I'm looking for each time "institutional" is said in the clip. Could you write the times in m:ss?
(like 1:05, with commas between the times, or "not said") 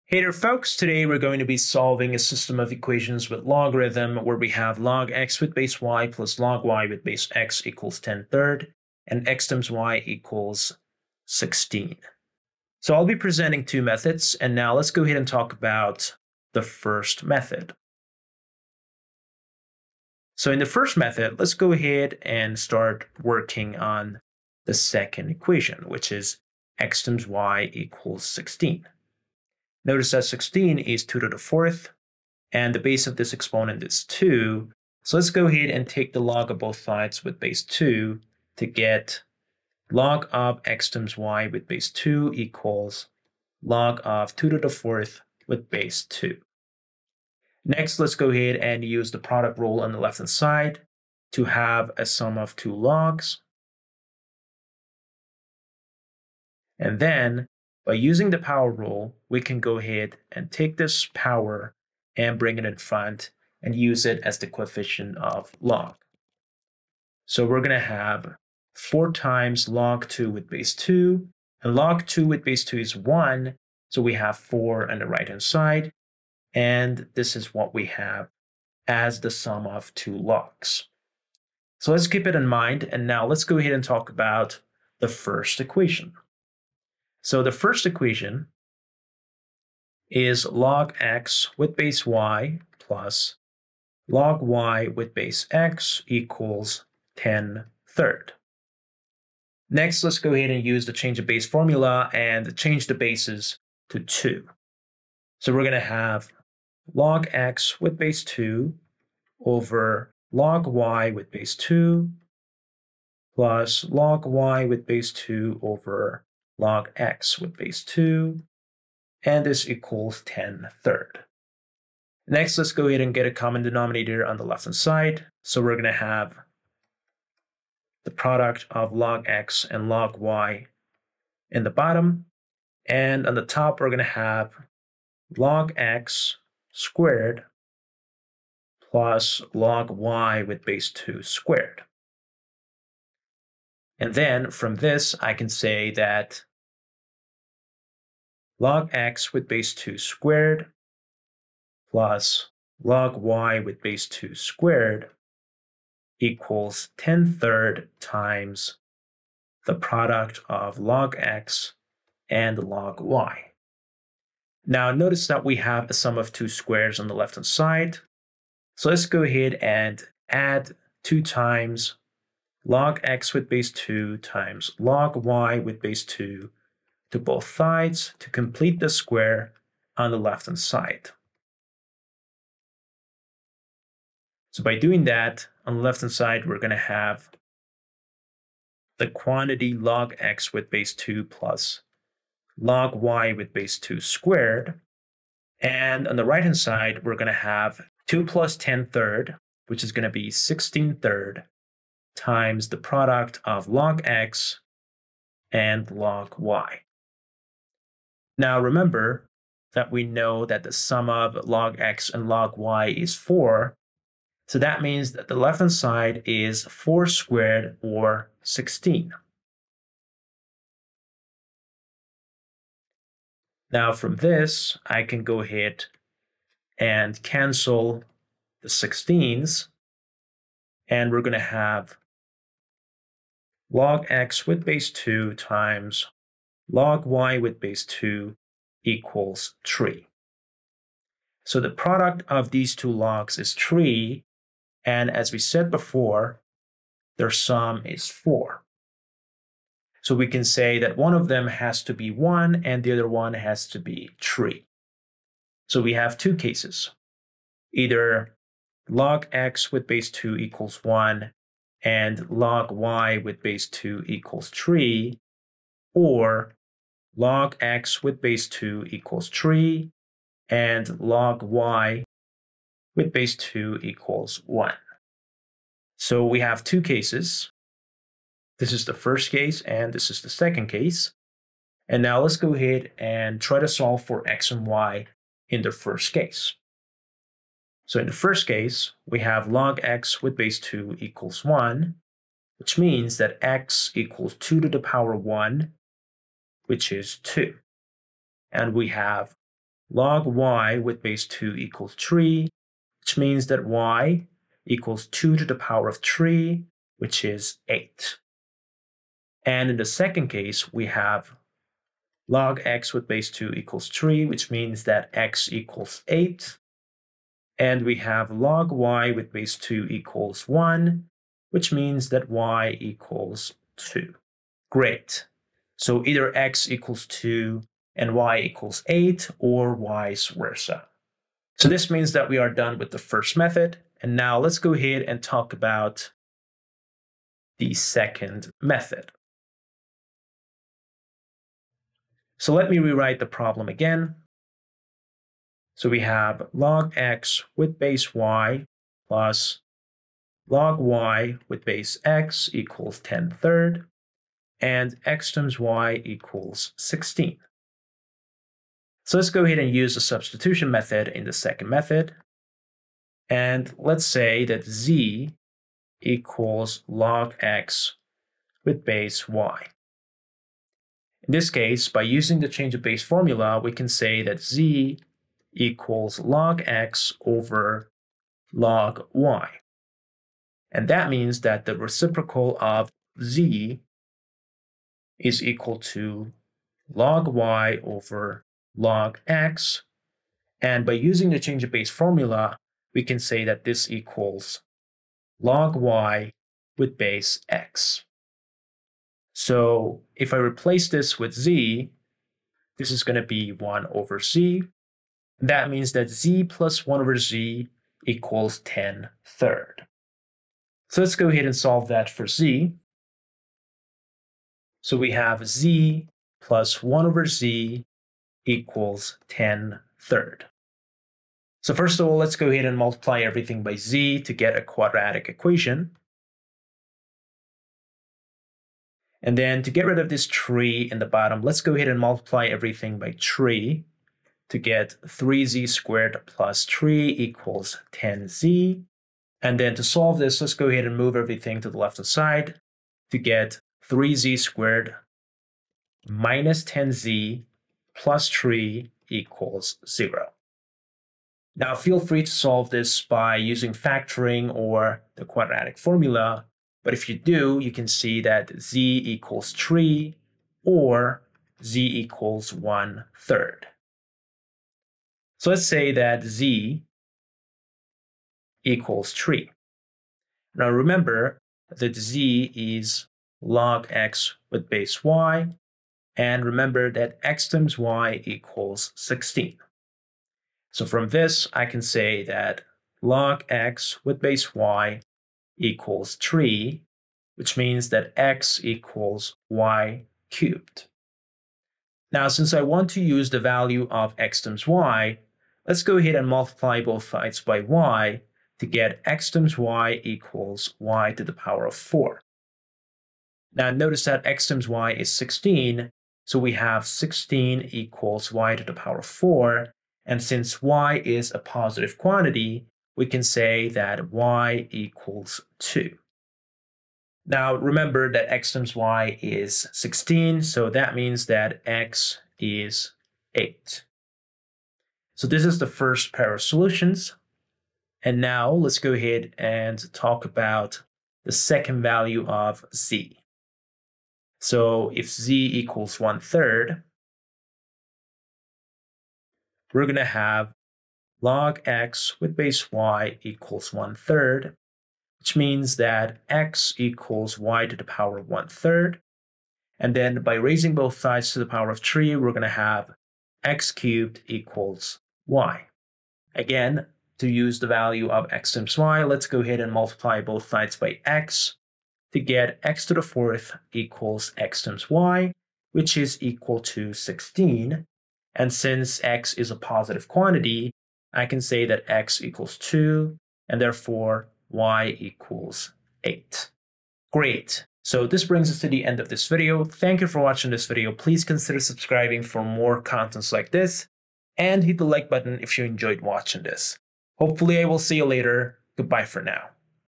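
not said.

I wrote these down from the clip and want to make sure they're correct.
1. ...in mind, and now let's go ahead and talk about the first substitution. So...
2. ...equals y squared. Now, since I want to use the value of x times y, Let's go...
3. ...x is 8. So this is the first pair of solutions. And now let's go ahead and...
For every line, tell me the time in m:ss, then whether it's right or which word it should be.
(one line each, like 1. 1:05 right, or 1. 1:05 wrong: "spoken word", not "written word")
1. 1:22 wrong: "equation", not "substitution"
2. 8:08 wrong: "cubed", not "squared"
3. 8:41 right.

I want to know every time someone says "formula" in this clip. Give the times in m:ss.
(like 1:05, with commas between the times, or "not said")
1:41, 6:13, 6:31, 7:35.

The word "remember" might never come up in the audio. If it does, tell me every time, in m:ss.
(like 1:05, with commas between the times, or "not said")
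3:28, 7:50, 7:56, 8:37.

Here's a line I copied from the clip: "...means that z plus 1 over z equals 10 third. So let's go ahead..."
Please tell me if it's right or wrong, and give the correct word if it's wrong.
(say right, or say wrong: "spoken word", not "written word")
right.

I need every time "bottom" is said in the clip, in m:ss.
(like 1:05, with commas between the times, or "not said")
2:11, 7:11.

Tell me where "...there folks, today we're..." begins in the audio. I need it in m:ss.
0:00.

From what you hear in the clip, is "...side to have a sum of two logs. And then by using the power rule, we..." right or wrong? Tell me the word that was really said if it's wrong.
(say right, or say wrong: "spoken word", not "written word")
right.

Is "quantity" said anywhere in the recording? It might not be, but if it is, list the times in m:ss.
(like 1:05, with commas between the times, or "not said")
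3:09, 8:31, 9:30.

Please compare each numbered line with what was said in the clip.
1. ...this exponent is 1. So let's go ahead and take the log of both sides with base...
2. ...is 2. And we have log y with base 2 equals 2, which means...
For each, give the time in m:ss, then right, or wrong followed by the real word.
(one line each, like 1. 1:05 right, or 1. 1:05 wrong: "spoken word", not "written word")
1. 0:33 wrong: "2", not "1"
2. 4:56 wrong: "3", not "2".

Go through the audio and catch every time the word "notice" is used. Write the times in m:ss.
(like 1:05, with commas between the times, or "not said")
0:29, 2:44, 8:23.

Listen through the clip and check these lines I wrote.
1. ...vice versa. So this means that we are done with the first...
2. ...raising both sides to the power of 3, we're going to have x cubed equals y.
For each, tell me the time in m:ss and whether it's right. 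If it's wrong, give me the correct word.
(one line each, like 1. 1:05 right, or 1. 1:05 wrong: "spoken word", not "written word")
1. 5:29 right
2. 9:10 right.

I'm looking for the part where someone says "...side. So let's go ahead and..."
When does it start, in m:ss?
2:47.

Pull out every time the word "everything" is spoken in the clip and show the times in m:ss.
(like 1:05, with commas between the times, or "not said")
7:03, 7:12, 7:21.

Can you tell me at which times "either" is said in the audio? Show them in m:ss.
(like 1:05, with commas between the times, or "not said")
4:17, 5:26.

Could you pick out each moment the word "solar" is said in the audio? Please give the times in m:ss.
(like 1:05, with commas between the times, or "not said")
not said.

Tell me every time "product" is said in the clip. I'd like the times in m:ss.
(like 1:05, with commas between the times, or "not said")
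0:49, 2:08, 2:39, 3:22, 4:01.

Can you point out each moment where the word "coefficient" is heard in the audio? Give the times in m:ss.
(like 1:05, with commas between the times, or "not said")
1:04.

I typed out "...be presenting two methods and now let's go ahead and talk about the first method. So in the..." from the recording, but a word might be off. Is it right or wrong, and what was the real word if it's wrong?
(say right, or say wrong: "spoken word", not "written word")
right.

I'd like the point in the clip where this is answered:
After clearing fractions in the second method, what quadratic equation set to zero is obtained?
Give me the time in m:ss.
7:23.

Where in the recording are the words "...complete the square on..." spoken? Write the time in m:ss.
2:58.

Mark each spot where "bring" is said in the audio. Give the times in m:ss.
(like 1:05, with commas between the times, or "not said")
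1:02, 9:38.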